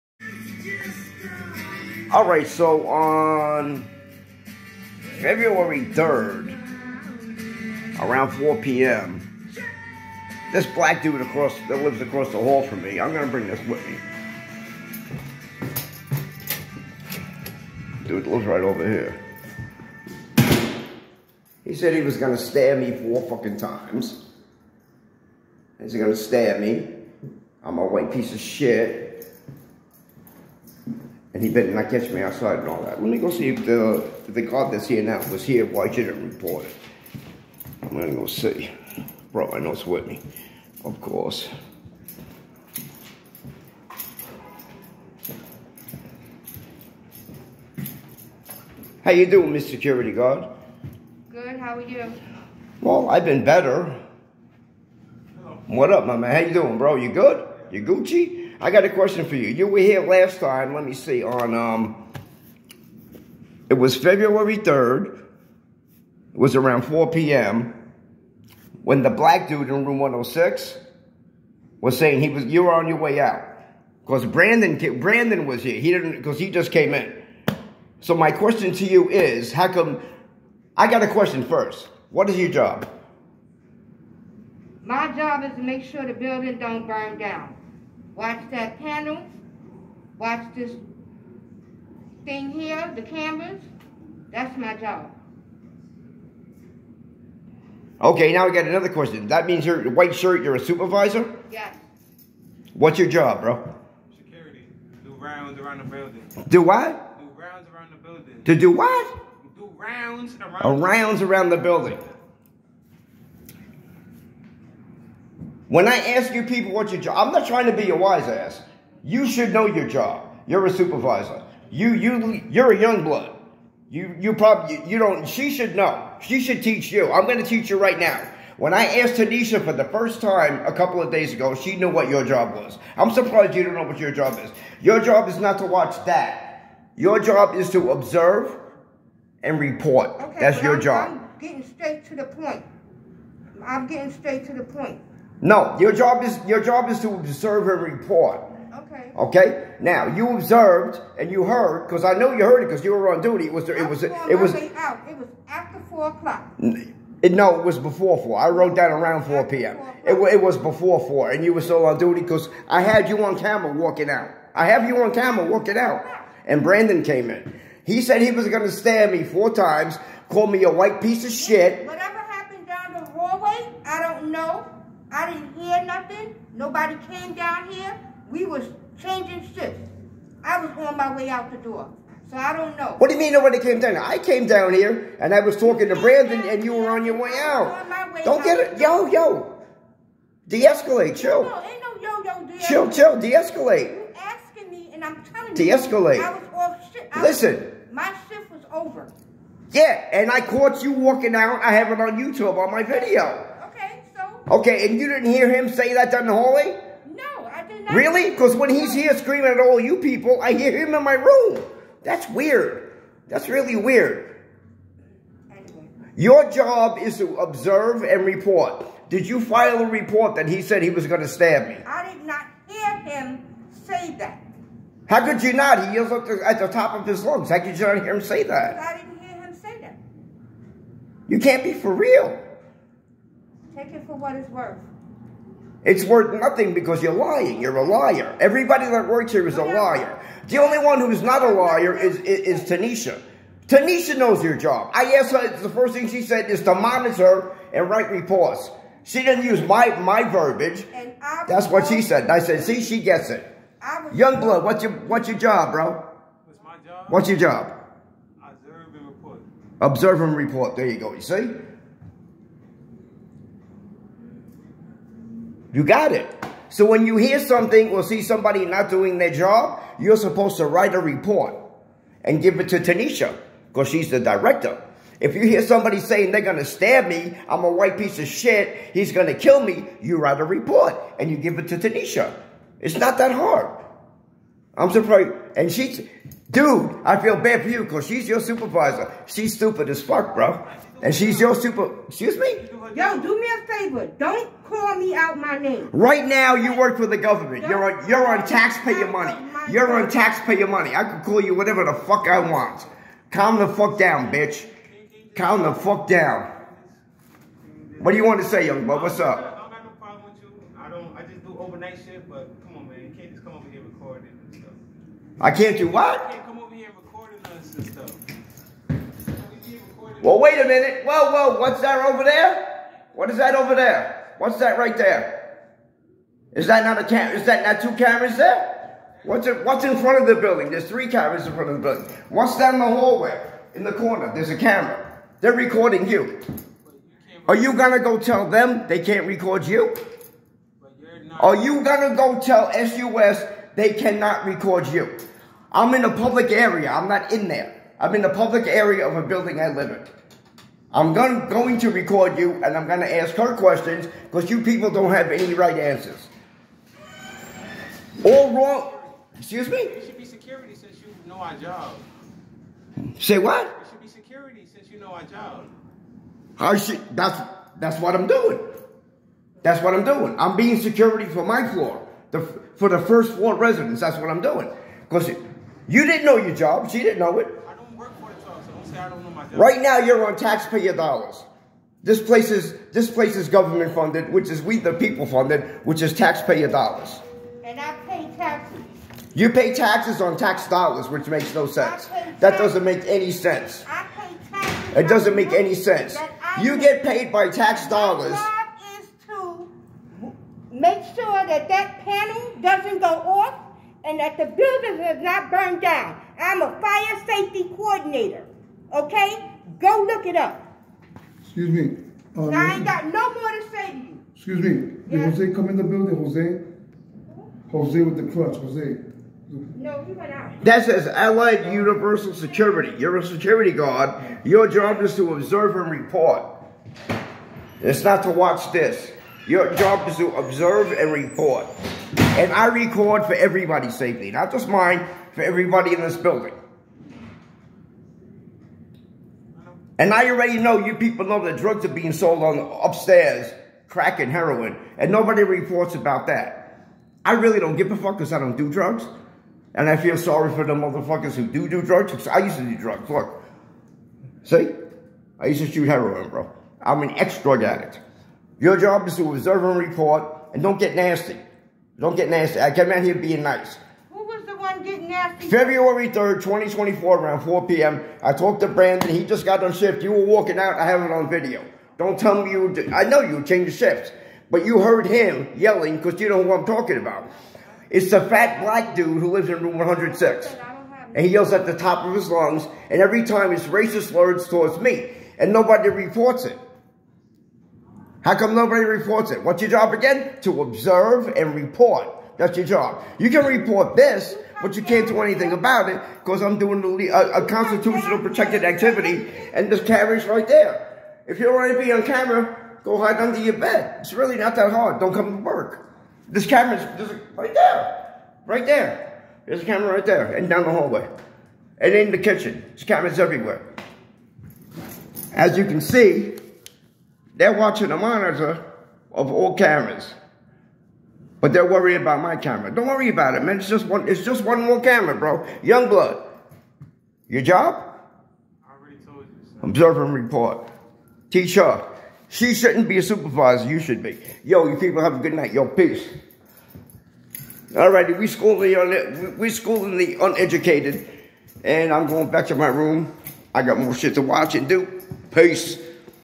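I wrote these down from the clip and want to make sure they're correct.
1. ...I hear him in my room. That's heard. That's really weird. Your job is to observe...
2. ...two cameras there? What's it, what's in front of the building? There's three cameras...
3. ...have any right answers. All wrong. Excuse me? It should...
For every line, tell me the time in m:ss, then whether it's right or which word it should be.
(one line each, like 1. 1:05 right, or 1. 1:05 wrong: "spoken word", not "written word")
1. 3:30 wrong: "weird", not "heard"
2. 5:27 right
3. 5:55 right.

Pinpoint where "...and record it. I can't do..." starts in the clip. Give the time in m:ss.
5:13.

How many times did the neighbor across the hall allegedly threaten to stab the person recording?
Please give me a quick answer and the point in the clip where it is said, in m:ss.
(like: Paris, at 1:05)
4, at 0:22.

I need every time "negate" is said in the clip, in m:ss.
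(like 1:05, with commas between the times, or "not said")
not said.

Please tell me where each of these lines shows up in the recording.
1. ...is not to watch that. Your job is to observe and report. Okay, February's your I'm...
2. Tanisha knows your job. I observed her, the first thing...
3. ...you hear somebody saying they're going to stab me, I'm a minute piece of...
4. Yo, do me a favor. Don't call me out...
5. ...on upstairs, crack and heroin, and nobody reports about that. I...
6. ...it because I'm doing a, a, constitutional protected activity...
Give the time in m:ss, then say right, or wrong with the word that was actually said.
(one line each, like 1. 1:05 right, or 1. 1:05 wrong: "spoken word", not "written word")
1. 2:15 wrong: "That", not "February"
2. 4:03 wrong: "asked", not "observed"
3. 4:35 wrong: "white", not "minute"
4. 4:52 right
5. 7:22 right
6. 8:15 right.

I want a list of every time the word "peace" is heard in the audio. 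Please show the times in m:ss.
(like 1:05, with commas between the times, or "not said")
8:55, 9:05.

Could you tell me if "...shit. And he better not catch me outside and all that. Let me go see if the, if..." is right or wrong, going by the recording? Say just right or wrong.
right.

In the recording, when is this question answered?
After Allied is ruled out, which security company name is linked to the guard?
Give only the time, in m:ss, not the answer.
7:01.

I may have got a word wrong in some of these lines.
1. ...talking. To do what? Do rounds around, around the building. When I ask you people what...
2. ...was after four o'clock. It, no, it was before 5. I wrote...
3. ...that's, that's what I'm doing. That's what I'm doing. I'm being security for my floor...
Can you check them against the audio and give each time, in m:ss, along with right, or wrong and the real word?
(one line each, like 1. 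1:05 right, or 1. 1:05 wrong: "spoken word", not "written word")
1. 1:47 wrong: "building", not "talking"
2. 2:35 wrong: "4", not "5"
3. 6:07 right.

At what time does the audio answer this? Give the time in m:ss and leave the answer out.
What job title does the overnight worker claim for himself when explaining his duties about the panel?
6:46.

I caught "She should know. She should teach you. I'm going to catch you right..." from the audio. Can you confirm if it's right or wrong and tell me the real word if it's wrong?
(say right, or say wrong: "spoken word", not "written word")
wrong: "teach", not "catch".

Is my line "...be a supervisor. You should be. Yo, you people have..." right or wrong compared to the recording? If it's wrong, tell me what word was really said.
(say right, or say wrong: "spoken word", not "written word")
right.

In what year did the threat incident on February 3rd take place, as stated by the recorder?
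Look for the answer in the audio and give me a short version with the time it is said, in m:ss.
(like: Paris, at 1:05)
2024, at 7:46.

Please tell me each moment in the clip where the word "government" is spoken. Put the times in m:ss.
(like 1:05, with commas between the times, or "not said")
4:57, 6:23.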